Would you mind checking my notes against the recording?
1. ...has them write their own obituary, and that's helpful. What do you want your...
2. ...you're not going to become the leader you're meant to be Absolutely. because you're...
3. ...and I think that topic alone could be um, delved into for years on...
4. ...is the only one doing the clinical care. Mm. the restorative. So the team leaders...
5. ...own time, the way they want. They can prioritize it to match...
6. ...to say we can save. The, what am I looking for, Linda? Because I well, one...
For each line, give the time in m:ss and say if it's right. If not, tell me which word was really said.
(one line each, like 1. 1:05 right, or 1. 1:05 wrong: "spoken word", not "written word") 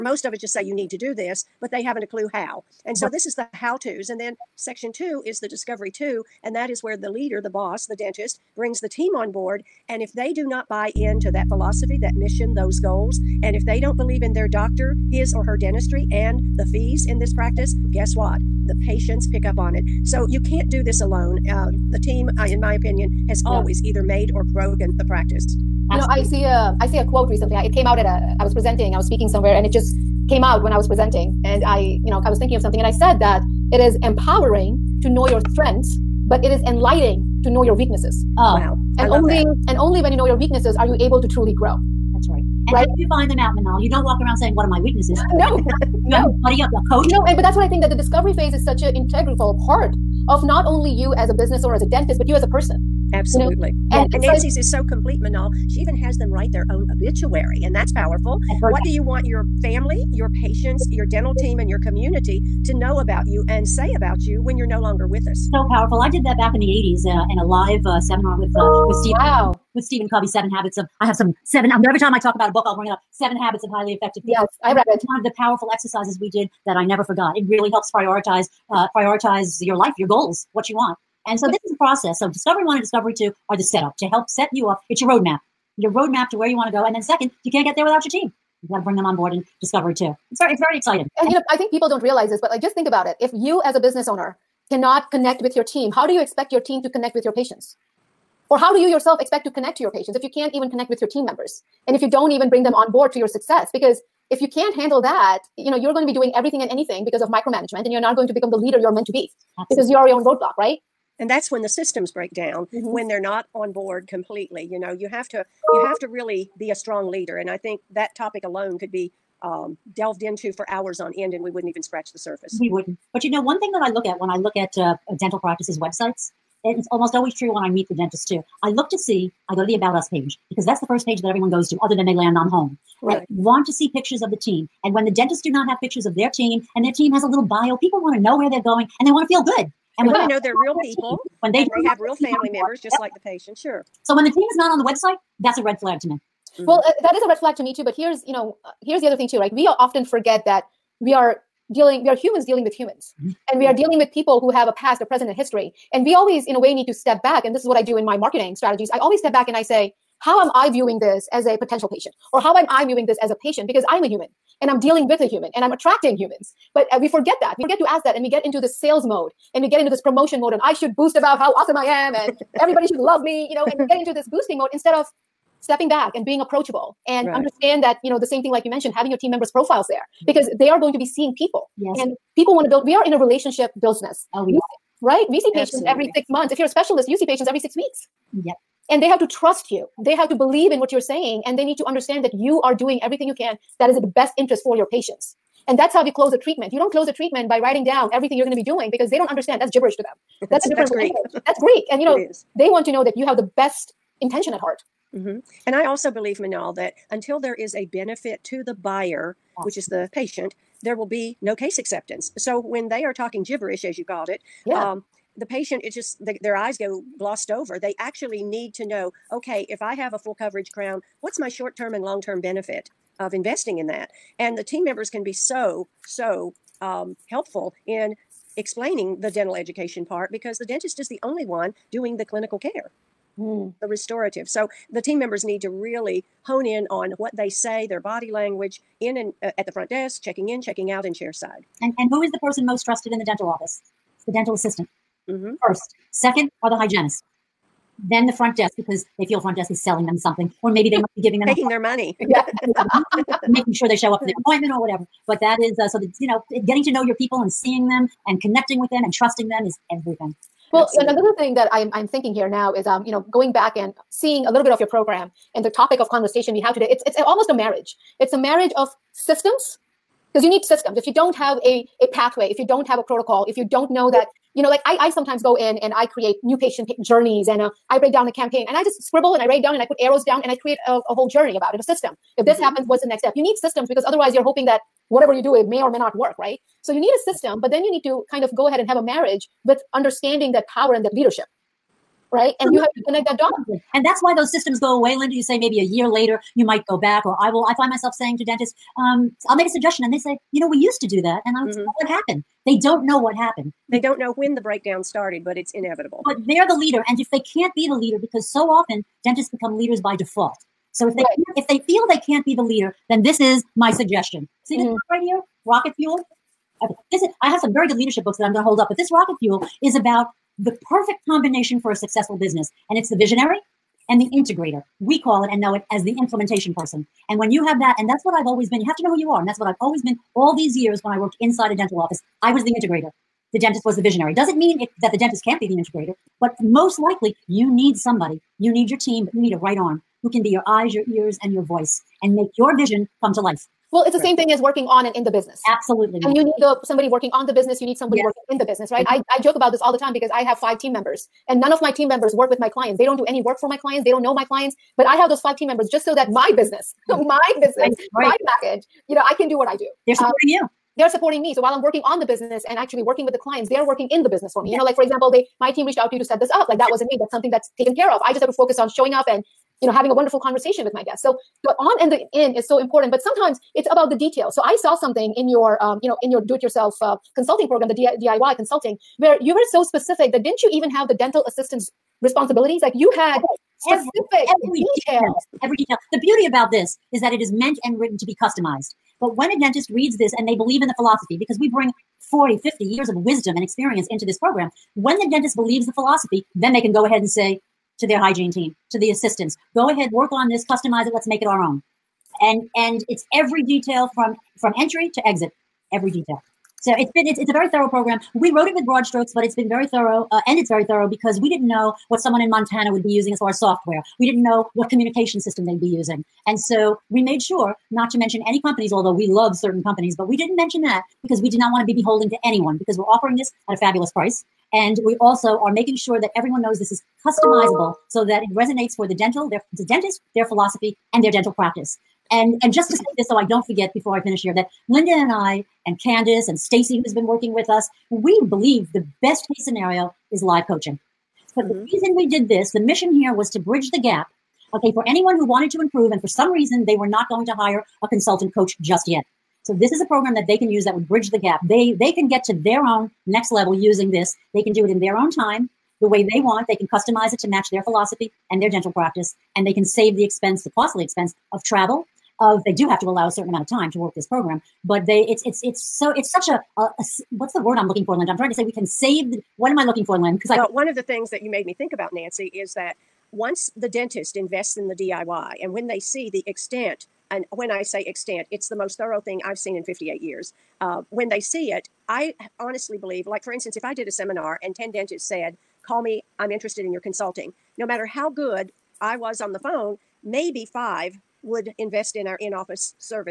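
1. 0:55 wrong: "powerful", not "helpful"
2. 1:47 right
3. 1:57 wrong: "hours", not "years"
4. 3:50 wrong: "members", not "leaders"
5. 7:35 wrong: "customize", not "prioritize"
6. 7:48 wrong: "Lynn", not "Linda".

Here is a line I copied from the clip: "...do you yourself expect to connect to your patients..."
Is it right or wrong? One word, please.
right.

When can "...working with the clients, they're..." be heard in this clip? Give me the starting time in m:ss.
6:03.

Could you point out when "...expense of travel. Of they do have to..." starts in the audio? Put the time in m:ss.
7:41.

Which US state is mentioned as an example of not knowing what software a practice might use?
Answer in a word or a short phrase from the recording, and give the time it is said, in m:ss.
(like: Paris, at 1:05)
Montana, at 6:52.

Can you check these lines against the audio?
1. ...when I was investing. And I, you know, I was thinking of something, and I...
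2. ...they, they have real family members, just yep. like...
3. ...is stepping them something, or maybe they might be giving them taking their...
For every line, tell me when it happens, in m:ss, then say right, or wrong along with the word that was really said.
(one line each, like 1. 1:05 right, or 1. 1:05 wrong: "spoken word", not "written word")
1. 0:30 wrong: "presenting", not "investing"
2. 2:21 right
3. 4:09 wrong: "selling", not "stepping".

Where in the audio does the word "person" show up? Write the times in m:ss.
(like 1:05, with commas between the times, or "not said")
0:52, 4:02, 5:26.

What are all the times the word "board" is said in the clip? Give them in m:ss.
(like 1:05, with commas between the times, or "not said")
0:09, 1:29, 1:42, 1:53.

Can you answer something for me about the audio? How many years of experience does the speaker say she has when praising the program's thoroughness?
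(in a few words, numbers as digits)
58.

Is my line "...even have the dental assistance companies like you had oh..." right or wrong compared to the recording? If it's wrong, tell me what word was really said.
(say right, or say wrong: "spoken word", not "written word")
wrong: "responsibilities", not "companies".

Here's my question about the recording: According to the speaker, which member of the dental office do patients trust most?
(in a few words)
The dental assistant.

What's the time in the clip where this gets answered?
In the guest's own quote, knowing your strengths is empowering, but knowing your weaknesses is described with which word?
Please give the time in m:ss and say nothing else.
0:36.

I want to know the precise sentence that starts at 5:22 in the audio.
And it's the visionary and the integrator.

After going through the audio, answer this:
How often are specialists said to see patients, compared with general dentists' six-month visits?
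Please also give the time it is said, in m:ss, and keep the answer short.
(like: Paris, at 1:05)
Every 6 weeks, at 3:07.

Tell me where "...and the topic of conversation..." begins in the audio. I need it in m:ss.
4:25.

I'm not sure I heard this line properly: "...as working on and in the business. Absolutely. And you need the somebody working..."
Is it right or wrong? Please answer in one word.
right.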